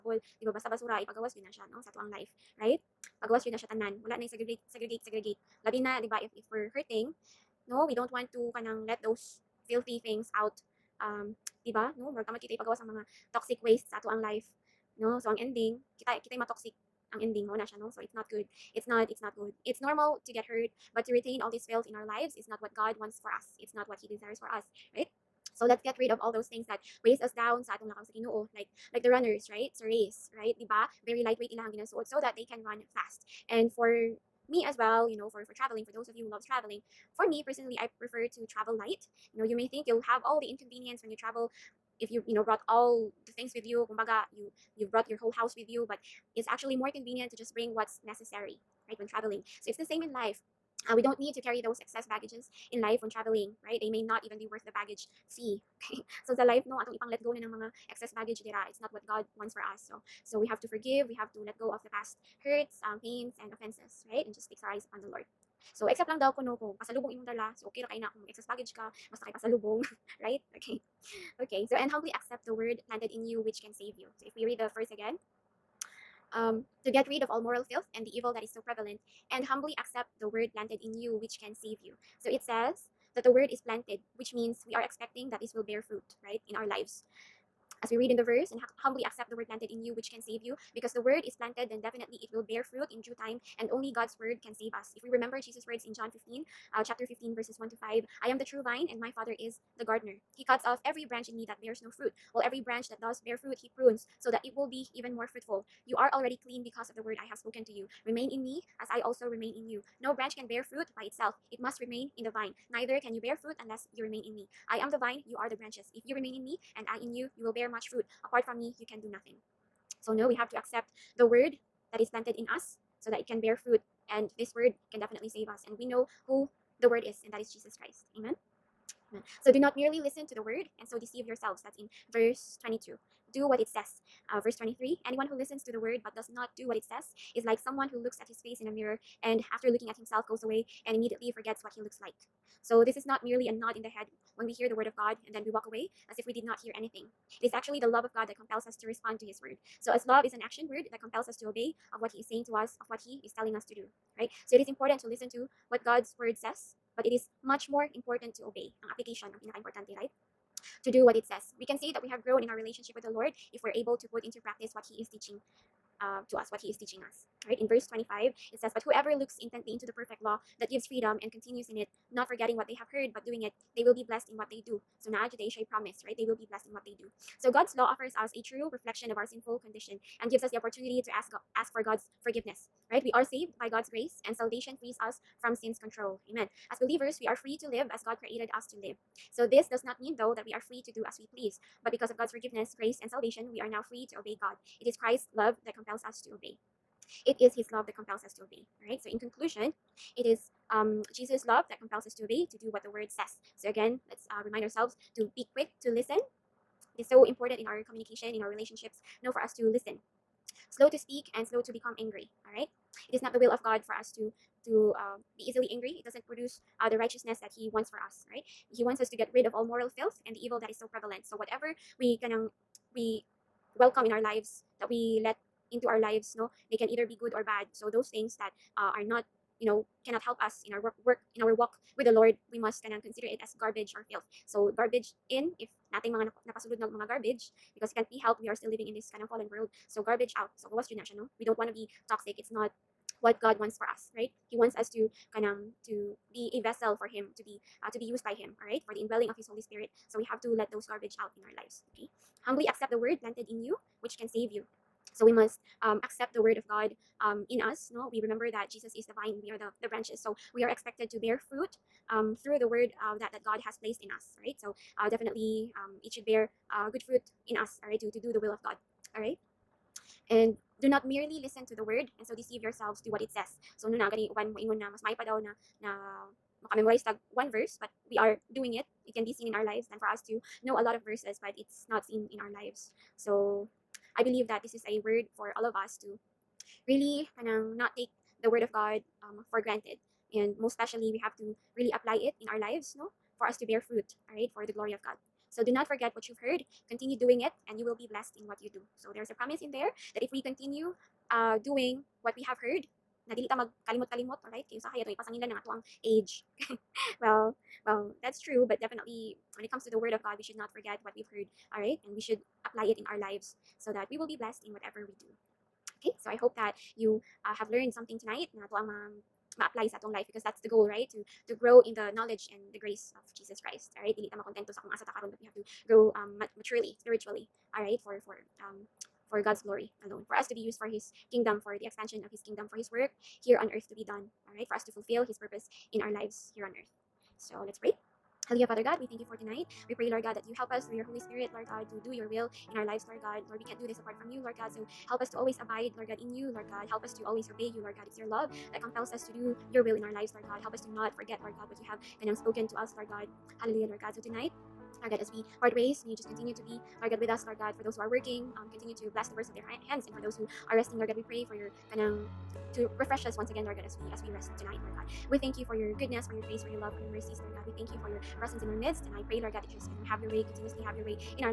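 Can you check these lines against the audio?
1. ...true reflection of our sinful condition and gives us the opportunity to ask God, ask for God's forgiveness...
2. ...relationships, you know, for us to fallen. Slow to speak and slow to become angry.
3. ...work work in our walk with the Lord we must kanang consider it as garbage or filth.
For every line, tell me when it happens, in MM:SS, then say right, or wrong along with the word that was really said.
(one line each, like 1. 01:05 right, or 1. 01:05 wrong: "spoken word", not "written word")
1. 02:58 right
2. 03:28 wrong: "listen", not "fallen"
3. 03:50 right.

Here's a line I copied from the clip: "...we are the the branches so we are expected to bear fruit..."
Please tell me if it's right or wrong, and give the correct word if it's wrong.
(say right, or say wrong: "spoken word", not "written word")
right.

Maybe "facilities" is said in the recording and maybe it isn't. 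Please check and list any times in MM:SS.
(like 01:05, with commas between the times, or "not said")
not said.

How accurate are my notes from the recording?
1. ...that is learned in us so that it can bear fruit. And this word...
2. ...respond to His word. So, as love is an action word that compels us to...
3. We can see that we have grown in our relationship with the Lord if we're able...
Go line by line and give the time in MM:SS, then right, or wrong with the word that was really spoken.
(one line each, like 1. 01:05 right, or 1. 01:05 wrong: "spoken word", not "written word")
1. 02:01 wrong: "planted", not "learned"
2. 02:28 right
3. 02:41 right.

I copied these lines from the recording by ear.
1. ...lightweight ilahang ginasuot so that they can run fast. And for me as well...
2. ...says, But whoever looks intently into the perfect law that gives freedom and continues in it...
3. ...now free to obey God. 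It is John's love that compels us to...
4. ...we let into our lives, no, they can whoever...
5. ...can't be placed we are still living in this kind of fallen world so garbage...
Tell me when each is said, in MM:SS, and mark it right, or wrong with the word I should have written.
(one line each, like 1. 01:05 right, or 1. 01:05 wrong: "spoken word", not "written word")
1. 00:31 right
2. 02:48 right
3. 03:13 wrong: "Christ", not "John"
4. 03:44 wrong: "either", not "whoever"
5. 03:57 wrong: "helped", not "placed".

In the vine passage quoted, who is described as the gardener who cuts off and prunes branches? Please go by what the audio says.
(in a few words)
my Father.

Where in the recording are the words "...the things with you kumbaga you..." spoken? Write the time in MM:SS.
00:43.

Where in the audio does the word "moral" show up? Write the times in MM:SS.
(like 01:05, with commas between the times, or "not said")
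01:17, 03:39.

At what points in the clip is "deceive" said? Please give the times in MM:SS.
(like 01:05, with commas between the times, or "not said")
02:10, 04:32.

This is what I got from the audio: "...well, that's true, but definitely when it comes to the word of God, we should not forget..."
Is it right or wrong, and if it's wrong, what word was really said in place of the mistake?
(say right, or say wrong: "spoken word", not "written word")
right.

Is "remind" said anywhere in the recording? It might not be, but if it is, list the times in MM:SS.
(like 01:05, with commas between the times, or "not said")
03:24.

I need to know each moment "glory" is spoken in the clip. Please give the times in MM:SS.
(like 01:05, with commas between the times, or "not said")
04:54, 05:29.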